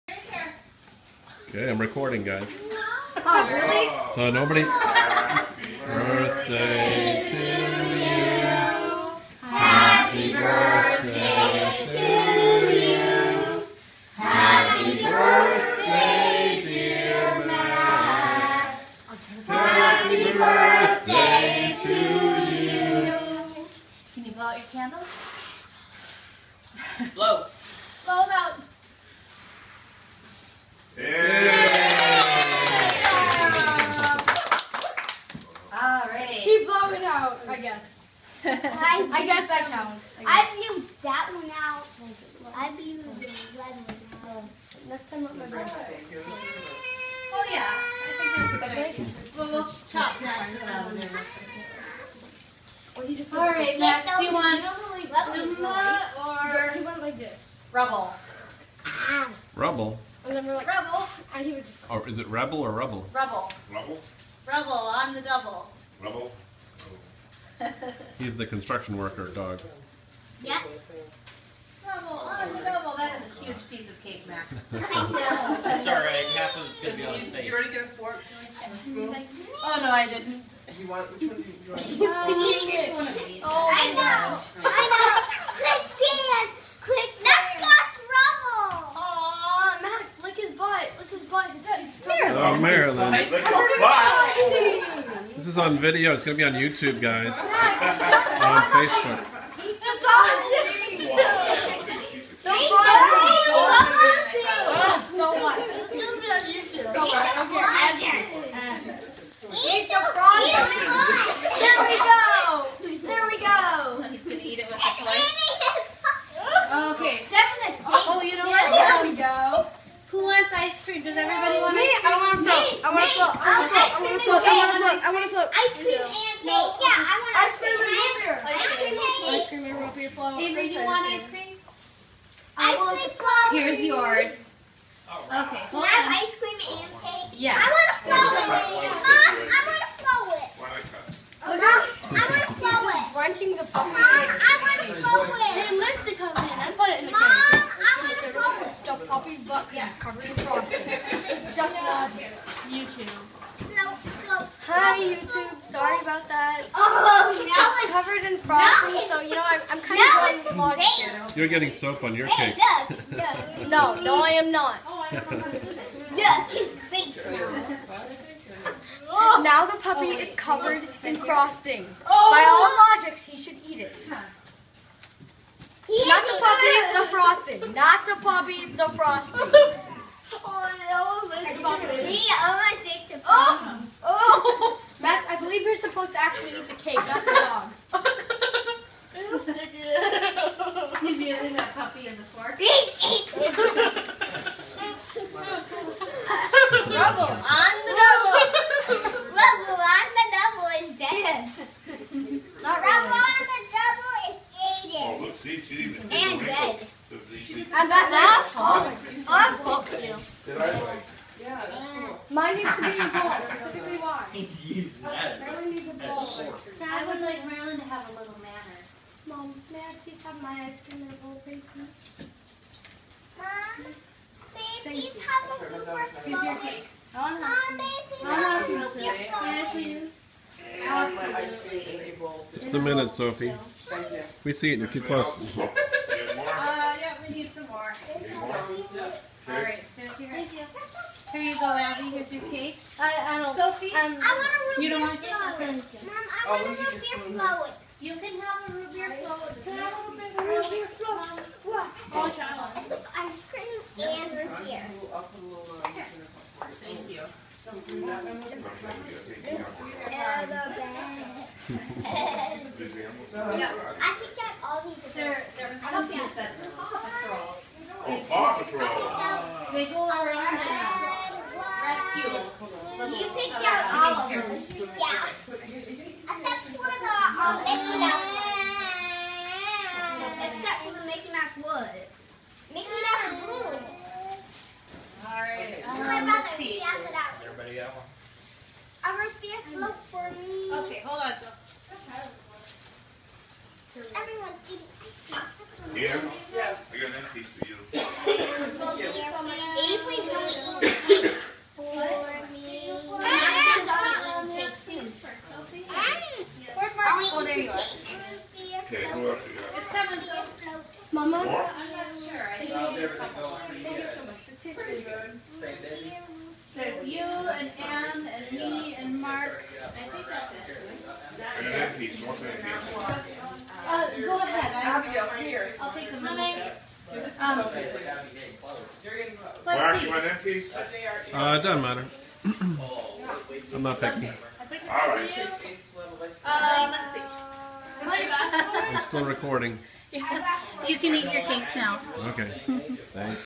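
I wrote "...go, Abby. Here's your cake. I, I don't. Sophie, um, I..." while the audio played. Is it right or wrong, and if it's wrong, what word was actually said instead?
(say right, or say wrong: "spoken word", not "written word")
right.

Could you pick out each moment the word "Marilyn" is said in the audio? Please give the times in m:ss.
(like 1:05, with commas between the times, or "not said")
1:32, 3:37.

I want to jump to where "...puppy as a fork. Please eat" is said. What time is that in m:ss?
3:11.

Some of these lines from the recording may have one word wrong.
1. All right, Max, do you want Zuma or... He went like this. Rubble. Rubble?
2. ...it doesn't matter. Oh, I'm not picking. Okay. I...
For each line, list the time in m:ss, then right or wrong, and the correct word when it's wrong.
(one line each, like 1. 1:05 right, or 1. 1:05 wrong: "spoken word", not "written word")
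1. 0:53 right
2. 5:31 right.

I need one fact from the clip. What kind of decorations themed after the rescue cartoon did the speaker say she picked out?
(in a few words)
pumpkins.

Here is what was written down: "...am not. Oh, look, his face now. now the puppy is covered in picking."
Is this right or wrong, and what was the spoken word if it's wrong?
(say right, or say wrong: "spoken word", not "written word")
wrong: "frosting", not "picking".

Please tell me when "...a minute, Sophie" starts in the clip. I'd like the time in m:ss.
3:52.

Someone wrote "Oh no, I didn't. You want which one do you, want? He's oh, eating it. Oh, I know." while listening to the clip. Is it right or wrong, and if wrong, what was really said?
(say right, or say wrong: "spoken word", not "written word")
right.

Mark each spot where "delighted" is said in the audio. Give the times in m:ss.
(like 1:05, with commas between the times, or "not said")
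not said.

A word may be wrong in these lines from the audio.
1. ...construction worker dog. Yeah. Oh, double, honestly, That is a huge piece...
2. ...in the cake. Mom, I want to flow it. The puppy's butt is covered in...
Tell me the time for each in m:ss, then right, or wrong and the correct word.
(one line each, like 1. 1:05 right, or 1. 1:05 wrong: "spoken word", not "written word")
1. 1:08 right
2. 2:27 right.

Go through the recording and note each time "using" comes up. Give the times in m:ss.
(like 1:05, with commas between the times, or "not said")
3:11, 3:34.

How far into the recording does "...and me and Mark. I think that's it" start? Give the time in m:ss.
5:18.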